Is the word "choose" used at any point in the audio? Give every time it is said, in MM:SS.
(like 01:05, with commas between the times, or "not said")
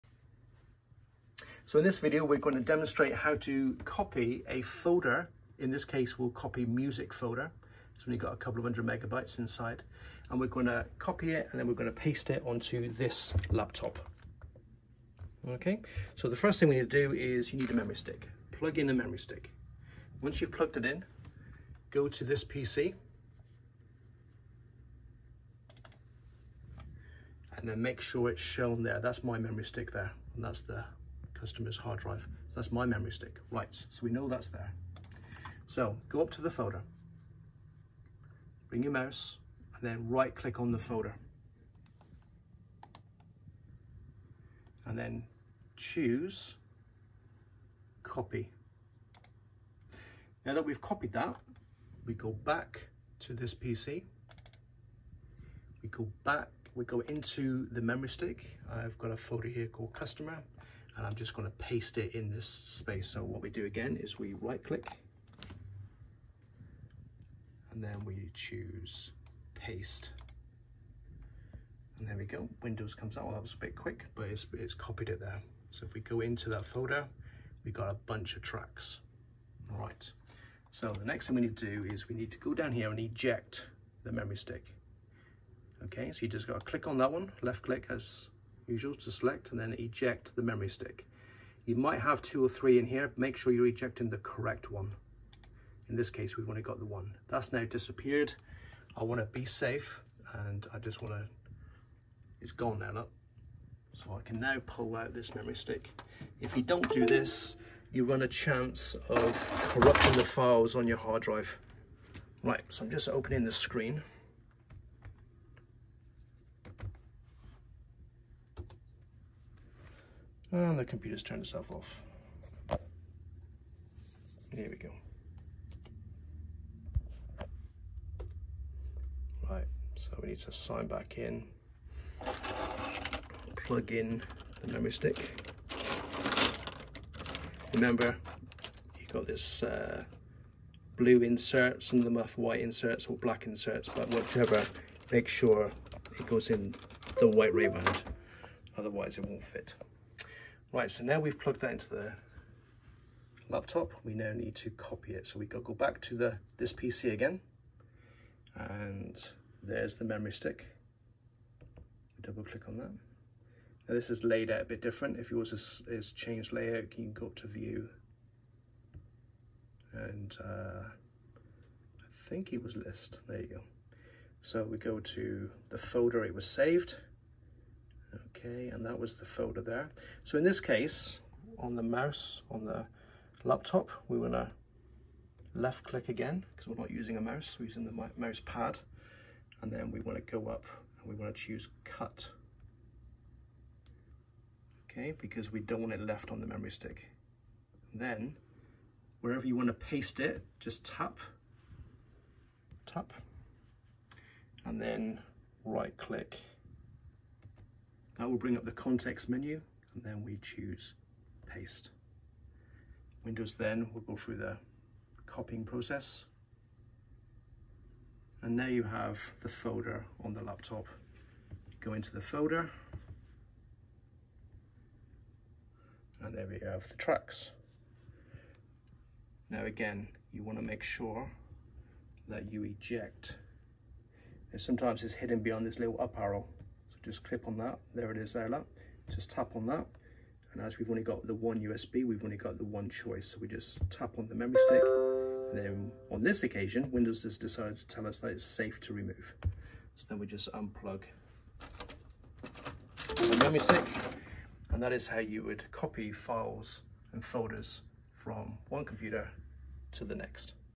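00:45, 01:08, 03:11, 03:30.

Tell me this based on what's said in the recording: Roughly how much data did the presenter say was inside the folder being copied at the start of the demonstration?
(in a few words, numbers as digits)
a couple of hundred megabytes.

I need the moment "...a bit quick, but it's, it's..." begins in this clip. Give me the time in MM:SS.
01:13.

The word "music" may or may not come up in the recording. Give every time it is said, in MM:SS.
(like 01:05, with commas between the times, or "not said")
00:06.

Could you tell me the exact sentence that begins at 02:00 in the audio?
And the computer's turned itself off.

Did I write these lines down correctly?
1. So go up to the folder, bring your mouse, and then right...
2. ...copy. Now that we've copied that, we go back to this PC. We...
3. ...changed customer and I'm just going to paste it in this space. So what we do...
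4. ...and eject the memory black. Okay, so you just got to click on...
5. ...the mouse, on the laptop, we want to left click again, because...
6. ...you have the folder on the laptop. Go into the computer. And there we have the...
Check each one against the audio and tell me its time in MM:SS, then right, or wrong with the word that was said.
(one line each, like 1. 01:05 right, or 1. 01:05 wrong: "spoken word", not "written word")
1. 00:35 right
2. 00:48 right
3. 00:59 wrong: "called", not "changed"
4. 01:22 wrong: "stick", not "black"
5. 03:01 right
6. 03:38 wrong: "folder", not "computer".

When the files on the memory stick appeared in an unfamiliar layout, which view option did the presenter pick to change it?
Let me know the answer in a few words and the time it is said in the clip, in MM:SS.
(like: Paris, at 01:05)
list, at 02:52.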